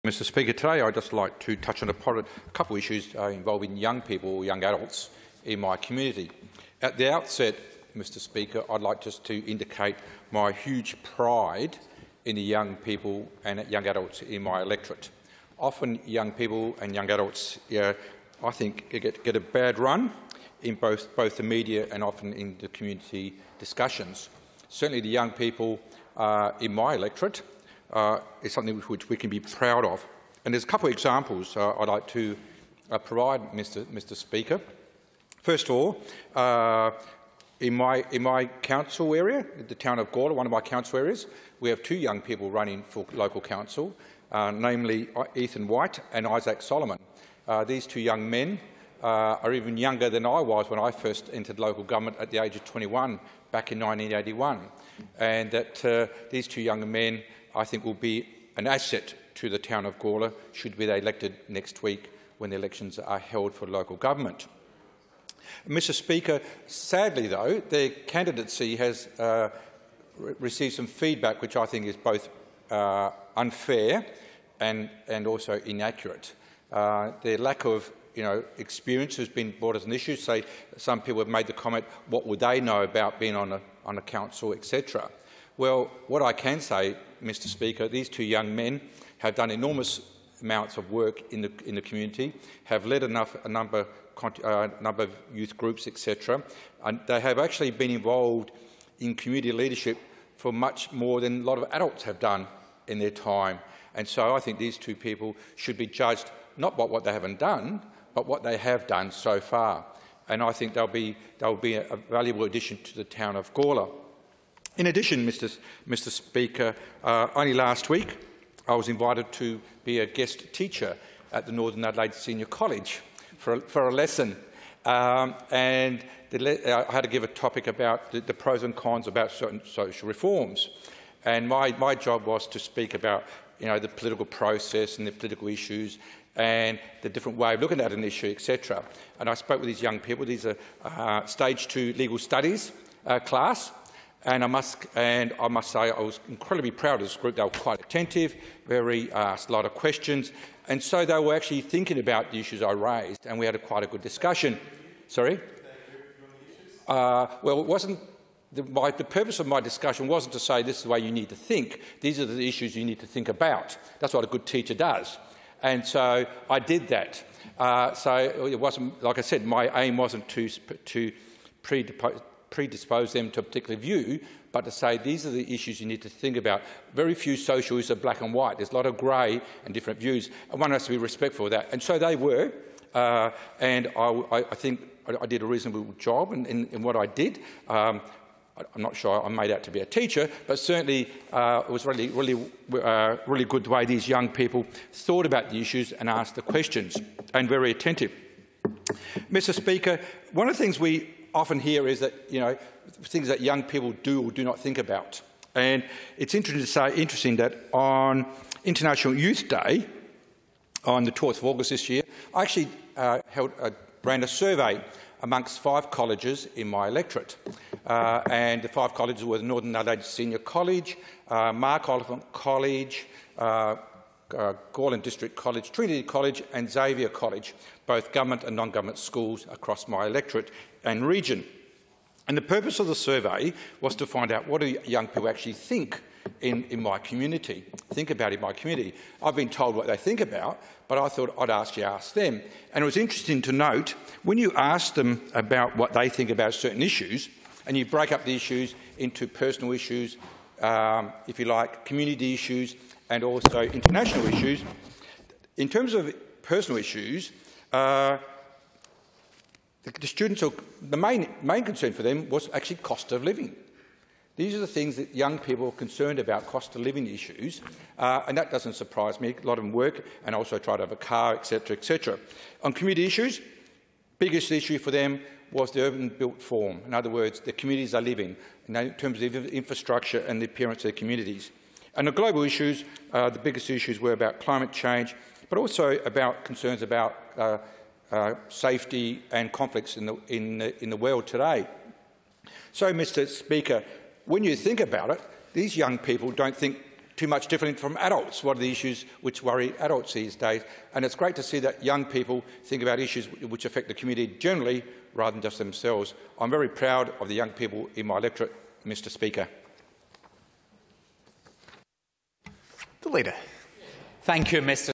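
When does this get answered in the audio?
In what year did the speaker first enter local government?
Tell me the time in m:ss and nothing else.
0:53.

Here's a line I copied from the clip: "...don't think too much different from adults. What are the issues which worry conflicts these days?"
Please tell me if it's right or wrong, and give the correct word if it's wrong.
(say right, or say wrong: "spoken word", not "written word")
wrong: "adults", not "conflicts".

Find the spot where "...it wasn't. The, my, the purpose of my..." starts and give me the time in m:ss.
2:37.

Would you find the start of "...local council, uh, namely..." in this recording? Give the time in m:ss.
0:43.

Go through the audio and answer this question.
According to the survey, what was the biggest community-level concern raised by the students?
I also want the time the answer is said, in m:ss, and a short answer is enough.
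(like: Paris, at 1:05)
Urban built form, at 4:35.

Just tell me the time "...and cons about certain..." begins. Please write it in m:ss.
2:08.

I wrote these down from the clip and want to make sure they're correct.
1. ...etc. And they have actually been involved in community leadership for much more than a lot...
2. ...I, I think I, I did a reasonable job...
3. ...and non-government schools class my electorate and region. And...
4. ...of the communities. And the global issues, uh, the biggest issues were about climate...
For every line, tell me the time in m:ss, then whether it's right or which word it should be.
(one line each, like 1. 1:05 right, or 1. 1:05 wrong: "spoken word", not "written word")
1. 1:35 right
2. 3:03 right
3. 3:48 wrong: "across", not "class"
4. 4:40 right.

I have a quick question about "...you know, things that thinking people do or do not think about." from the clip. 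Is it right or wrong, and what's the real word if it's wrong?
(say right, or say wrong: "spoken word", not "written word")
wrong: "young", not "thinking".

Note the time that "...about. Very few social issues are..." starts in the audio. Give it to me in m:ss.
2:56.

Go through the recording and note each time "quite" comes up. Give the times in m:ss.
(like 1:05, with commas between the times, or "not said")
2:27, 2:33.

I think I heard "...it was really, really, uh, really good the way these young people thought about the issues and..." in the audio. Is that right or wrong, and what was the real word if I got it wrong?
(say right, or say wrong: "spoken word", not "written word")
right.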